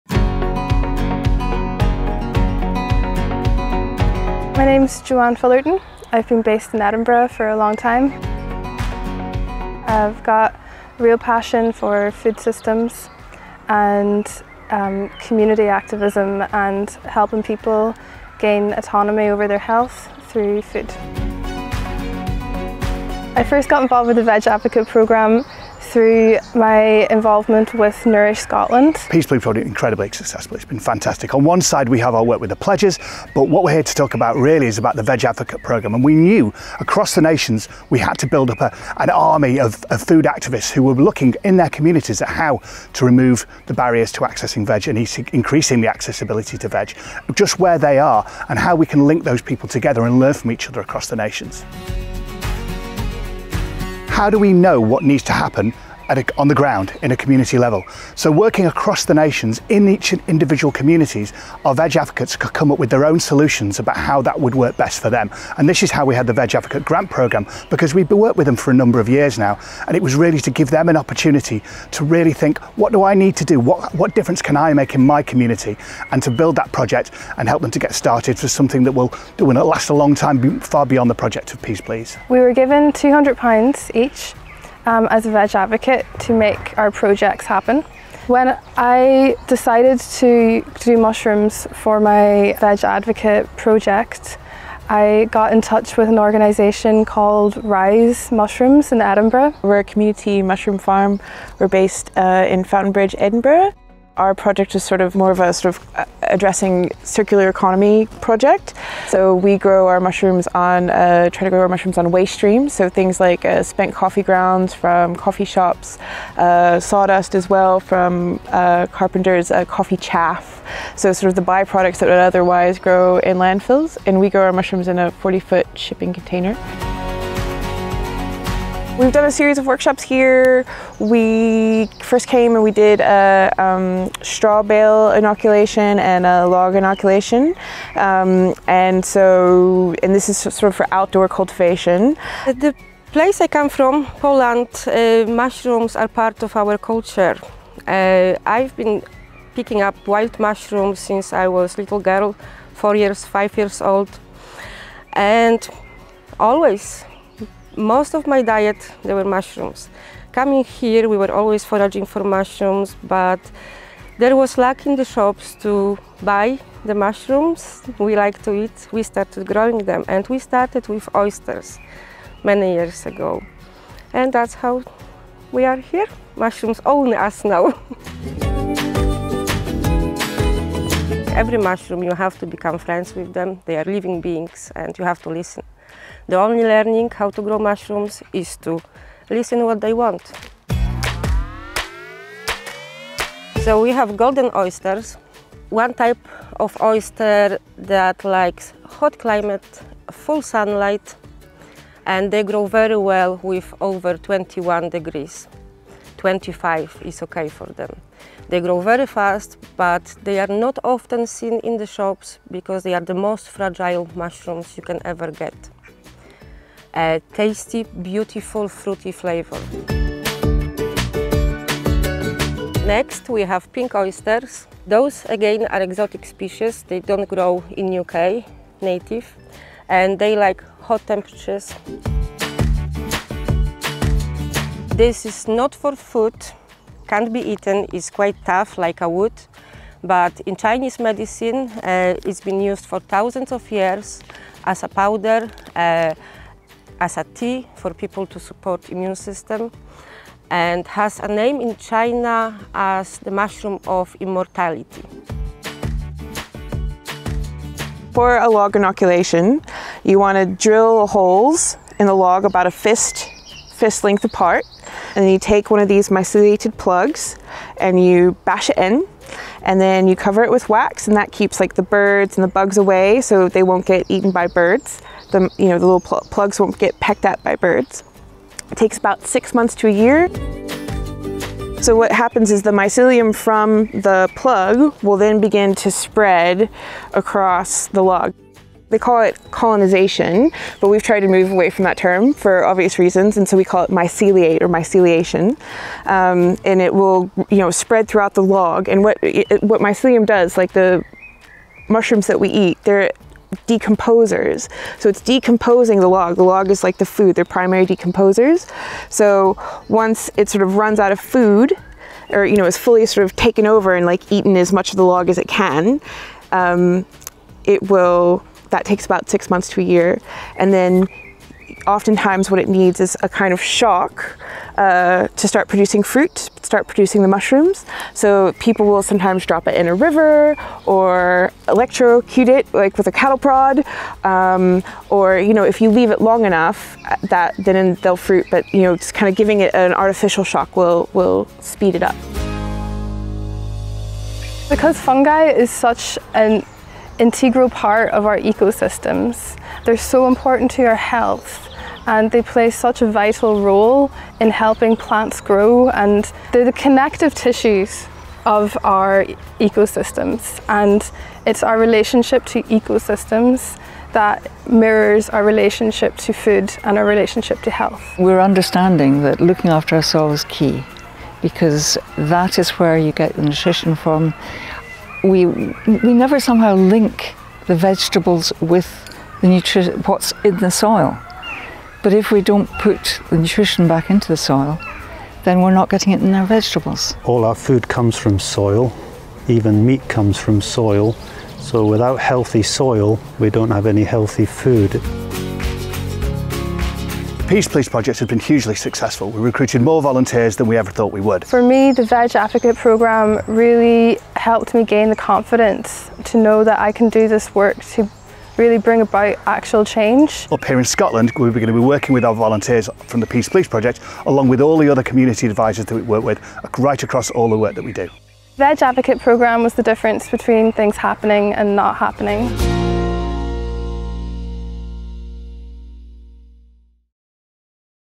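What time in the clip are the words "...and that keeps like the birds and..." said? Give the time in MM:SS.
04:31.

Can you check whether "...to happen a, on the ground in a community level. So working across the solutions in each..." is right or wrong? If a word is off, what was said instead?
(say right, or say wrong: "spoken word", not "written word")
wrong: "nations", not "solutions".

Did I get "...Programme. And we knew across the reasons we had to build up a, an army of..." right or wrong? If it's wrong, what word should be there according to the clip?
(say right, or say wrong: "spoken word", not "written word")
wrong: "nations", not "reasons".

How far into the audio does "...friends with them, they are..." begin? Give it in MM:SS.
03:02.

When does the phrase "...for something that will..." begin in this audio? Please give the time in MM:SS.
01:18.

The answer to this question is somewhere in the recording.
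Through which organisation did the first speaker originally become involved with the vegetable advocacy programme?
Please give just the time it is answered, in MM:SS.
00:28.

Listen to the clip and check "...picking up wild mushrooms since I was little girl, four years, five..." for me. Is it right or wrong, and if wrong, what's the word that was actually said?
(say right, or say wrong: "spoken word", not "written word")
right.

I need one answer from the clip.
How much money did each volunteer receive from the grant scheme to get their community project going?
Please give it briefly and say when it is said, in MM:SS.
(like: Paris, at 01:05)
£200, at 01:22.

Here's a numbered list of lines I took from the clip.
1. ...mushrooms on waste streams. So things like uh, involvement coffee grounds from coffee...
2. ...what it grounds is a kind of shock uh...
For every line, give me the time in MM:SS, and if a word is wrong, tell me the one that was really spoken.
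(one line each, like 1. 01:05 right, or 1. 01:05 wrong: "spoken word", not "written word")
1. 01:51 wrong: "spent", not "involvement"
2. 05:22 wrong: "needs", not "grounds".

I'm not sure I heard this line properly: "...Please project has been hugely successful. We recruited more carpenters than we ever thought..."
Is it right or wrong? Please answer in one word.
wrong.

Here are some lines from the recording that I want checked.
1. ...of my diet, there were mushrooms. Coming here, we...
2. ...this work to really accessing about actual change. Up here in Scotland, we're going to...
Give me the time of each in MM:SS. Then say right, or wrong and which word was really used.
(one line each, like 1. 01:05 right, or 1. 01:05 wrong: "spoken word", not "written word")
1. 02:38 right
2. 06:47 wrong: "bring", not "accessing".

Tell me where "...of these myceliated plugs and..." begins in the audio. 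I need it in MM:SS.
04:25.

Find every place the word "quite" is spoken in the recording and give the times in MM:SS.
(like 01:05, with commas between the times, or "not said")
03:58.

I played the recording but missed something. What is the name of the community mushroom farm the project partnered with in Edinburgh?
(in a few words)
Rise Mushrooms.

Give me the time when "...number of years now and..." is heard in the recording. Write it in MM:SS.
01:08.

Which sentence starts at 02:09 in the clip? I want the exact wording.
We've done a series of workshops here.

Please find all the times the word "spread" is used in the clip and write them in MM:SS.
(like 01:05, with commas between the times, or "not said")
04:45, 04:57.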